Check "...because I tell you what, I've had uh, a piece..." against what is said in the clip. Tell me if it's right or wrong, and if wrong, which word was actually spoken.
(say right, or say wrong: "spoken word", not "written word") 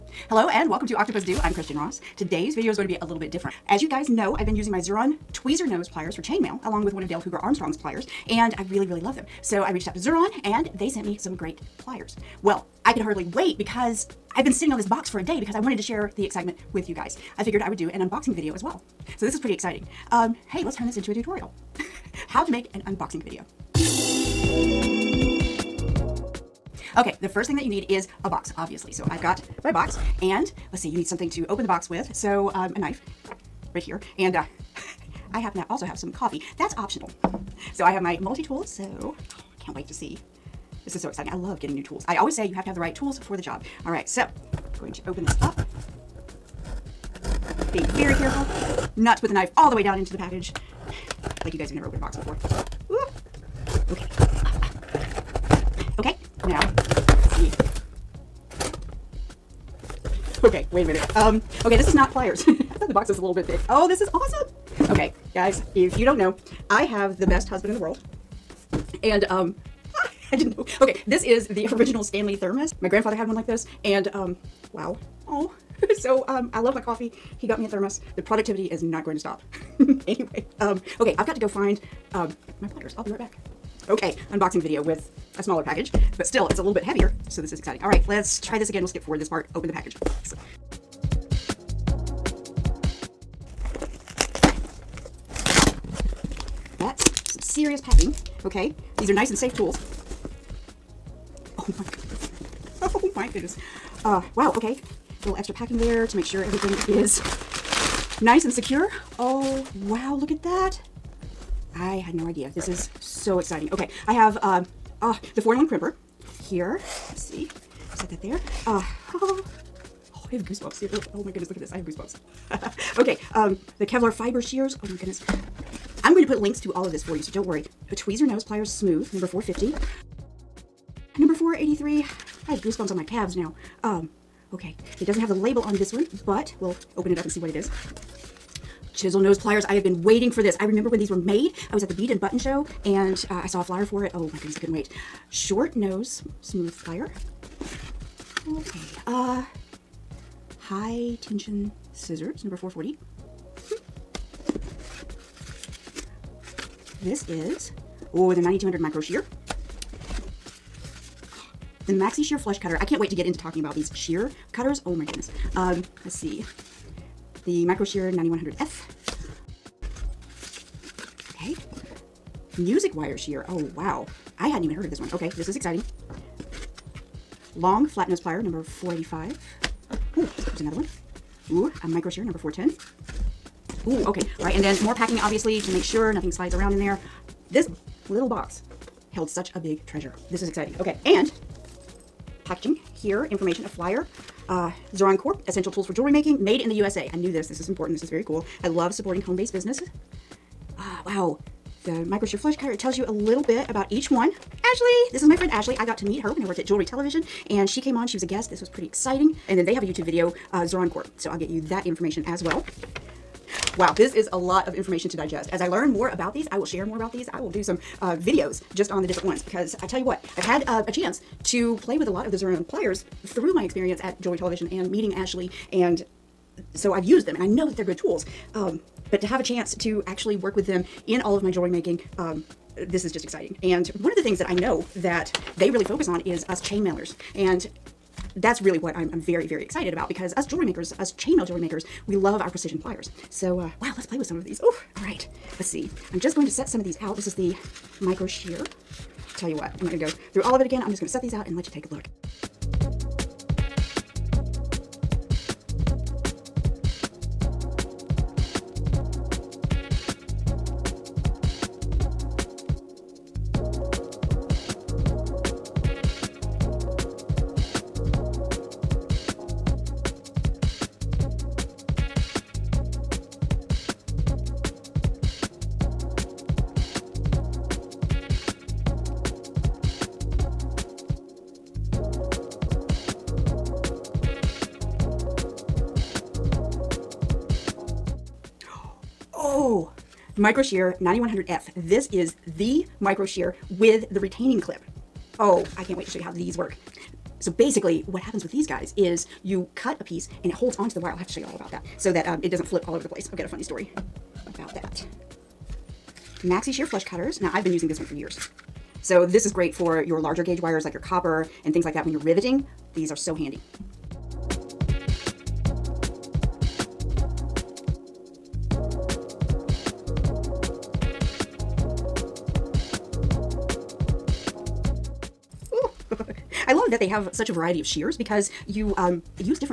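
wrong: "chance", not "piece".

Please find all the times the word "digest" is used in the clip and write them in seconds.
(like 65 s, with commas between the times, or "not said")
215 s.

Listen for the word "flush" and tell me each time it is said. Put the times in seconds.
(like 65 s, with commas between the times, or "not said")
162 s, 202 s, 306 s.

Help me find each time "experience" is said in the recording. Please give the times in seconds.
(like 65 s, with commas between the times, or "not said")
223 s.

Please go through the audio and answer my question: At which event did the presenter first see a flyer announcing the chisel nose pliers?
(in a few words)
The Bead and Button show.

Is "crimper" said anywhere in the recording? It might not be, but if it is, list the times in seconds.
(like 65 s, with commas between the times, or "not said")
115 s.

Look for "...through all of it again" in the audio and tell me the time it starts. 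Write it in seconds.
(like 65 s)
250 s.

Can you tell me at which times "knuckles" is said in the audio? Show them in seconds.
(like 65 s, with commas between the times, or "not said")
not said.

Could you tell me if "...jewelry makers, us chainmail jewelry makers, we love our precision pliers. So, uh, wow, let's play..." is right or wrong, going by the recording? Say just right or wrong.
right.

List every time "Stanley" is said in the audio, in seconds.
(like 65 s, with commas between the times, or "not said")
72 s.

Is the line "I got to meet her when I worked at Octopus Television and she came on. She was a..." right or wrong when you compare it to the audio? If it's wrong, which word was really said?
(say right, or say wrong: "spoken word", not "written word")
wrong: "Jewelry", not "Octopus".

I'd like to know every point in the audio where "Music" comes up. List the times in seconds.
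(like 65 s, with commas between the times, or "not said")
172 s.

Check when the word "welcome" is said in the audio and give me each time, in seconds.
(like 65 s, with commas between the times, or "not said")
0 s.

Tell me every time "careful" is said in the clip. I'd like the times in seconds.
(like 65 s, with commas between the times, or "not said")
48 s.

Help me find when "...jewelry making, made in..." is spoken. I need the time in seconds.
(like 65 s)
195 s.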